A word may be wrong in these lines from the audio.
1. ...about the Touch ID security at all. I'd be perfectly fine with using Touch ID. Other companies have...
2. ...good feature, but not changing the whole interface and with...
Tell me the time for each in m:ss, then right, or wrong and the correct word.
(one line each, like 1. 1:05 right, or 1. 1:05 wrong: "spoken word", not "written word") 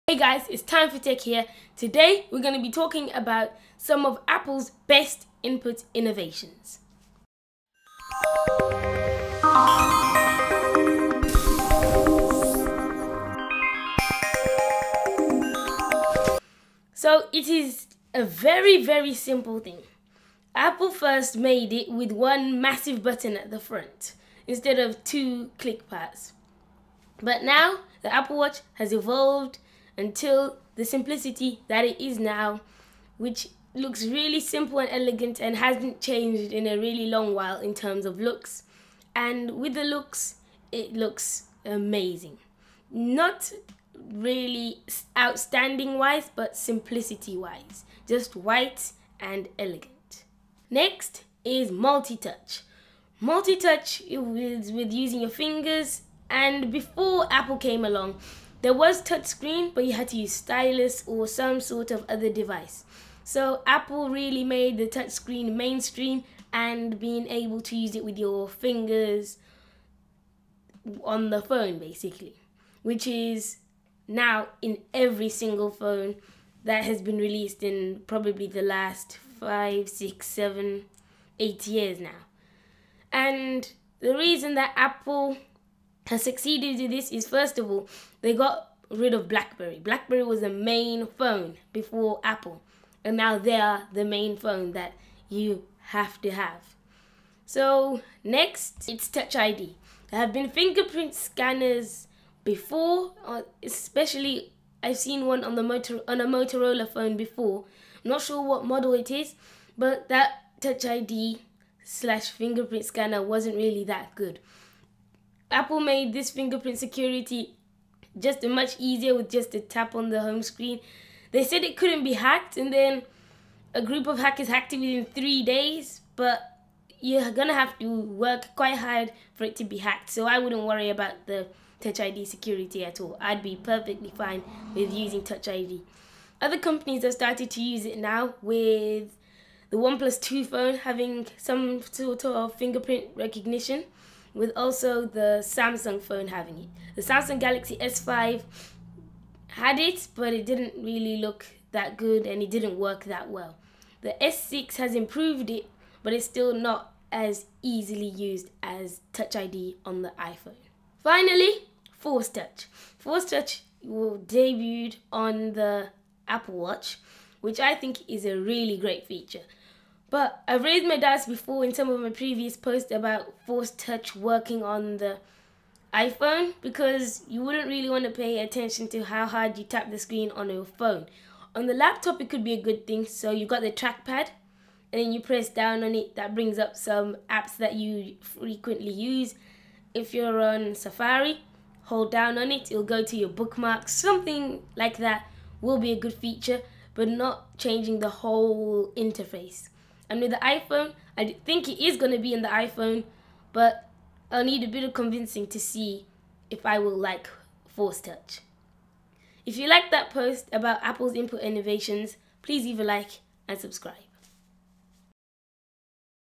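1. 2:10 right
2. 3:15 right.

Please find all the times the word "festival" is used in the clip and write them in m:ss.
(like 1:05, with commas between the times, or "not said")
not said.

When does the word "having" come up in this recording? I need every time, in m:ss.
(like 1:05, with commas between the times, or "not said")
2:20, 2:26.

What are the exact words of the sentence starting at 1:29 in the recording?
BlackBerry was the main phone before Apple, and now they are the main phone that you have to have.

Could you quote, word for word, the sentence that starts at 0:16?
So it is a very very simple thing.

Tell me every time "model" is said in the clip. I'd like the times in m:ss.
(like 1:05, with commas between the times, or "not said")
1:48.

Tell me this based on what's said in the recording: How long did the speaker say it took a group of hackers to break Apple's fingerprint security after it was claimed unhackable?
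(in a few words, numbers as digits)
3 days.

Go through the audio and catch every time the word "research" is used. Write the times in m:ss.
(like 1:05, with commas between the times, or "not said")
not said.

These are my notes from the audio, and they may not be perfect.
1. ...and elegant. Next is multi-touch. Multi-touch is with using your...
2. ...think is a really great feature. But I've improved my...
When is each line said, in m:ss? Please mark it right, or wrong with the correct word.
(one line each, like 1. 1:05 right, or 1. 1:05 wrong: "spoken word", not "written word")
1. 0:49 right
2. 2:47 wrong: "raised", not "improved".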